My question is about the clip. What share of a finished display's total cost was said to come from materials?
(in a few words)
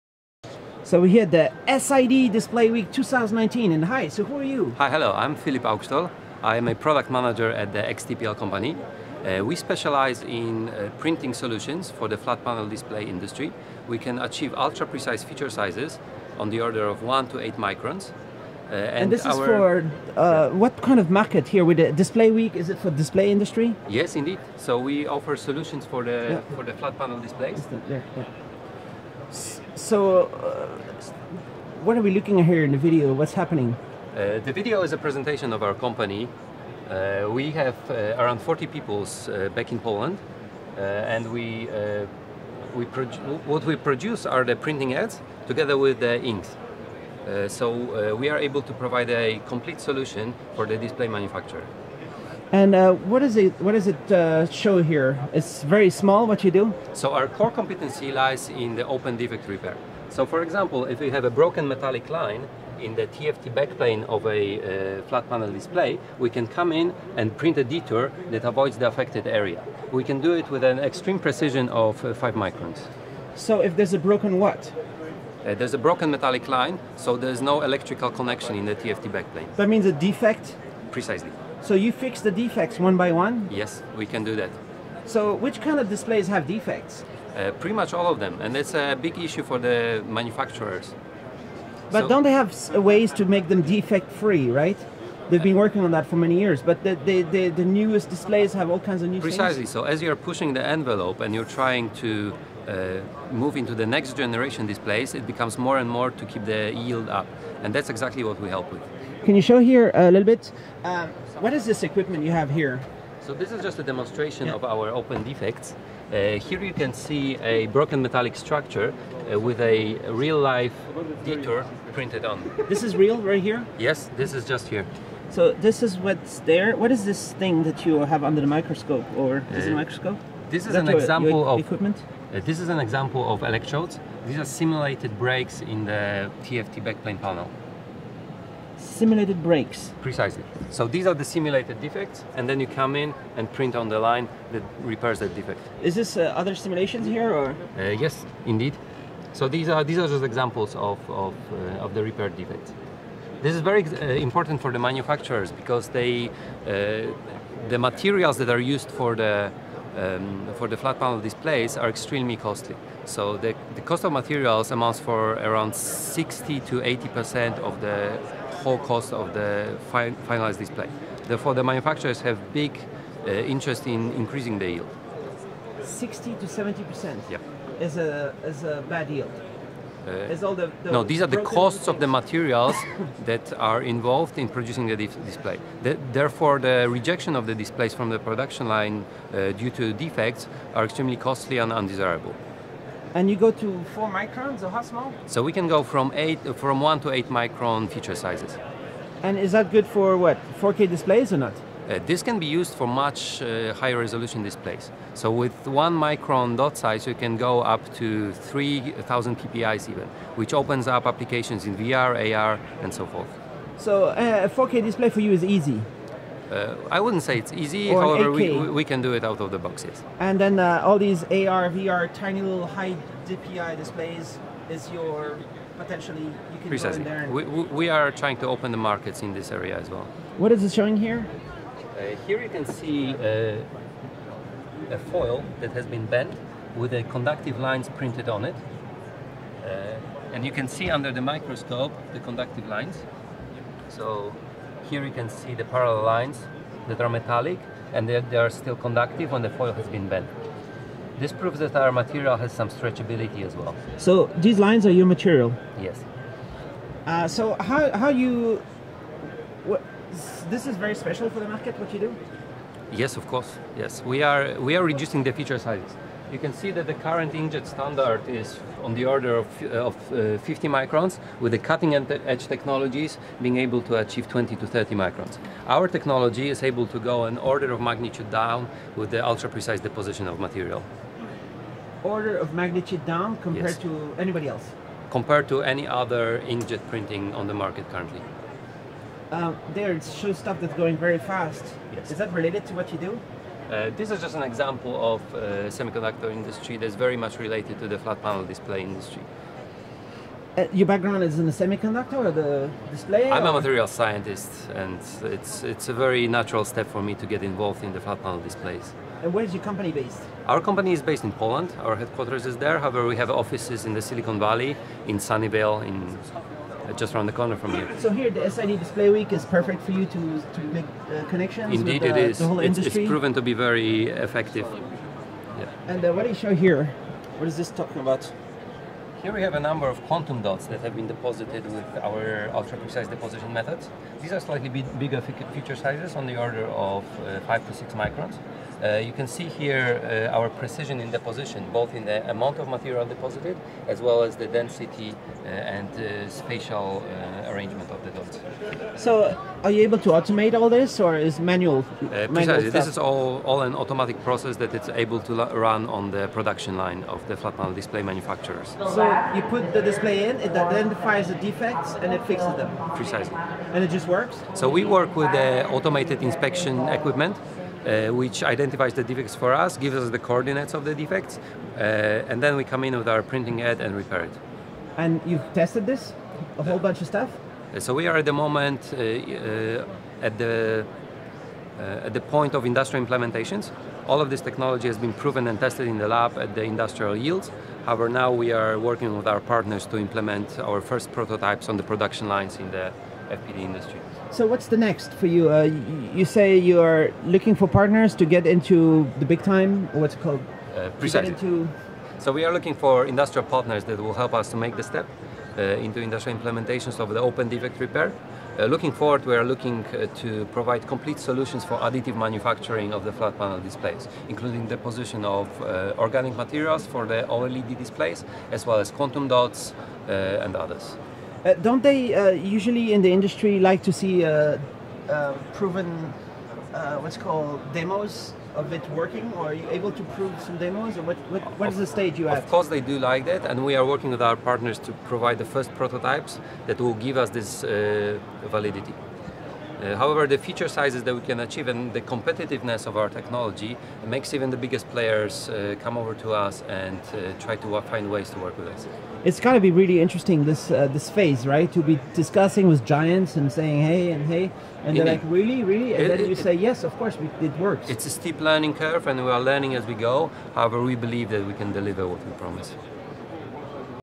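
60 to 80 percent.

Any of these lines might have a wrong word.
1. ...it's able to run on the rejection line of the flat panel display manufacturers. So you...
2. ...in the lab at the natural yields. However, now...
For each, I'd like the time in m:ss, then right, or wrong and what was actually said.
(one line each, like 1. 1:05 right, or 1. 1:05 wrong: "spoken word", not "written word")
1. 5:54 wrong: "production", not "rejection"
2. 6:25 wrong: "industrial", not "natural".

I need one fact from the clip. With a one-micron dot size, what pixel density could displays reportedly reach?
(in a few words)
3,000 PPI.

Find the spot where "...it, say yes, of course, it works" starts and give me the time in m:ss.
7:36.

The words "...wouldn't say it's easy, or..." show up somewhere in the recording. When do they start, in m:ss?
3:37.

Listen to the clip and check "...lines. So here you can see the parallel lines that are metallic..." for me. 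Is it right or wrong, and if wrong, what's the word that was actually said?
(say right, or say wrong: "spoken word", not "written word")
right.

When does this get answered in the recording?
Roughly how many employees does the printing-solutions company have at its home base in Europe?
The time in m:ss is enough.
0:38.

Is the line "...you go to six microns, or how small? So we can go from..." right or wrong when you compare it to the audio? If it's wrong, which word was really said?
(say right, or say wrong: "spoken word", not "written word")
wrong: "four", not "six".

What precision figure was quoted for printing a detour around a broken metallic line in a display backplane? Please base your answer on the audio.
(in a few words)
5 microns.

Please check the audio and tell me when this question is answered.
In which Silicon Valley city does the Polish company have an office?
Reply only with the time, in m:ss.
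5:15.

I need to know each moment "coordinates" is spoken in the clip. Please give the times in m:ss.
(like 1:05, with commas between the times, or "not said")
6:10.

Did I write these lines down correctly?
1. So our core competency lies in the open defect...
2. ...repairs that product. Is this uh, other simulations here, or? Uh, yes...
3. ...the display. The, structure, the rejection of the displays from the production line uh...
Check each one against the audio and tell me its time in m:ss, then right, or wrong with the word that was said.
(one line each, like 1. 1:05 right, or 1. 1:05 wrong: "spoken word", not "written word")
1. 0:56 right
2. 2:24 wrong: "defect", not "product"
3. 3:04 wrong: "therefore", not "structure".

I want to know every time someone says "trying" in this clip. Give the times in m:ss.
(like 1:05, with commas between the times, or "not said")
1:41, 3:48.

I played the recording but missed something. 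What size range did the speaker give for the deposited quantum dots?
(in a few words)
5 to 6 microns.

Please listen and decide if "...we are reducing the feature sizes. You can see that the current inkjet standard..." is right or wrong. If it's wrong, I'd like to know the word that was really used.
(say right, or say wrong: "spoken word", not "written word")
right.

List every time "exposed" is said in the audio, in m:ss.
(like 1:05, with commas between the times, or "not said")
not said.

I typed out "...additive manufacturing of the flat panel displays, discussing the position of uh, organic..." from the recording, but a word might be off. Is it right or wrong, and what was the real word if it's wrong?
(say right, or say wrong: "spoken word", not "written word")
wrong: "including", not "discussing".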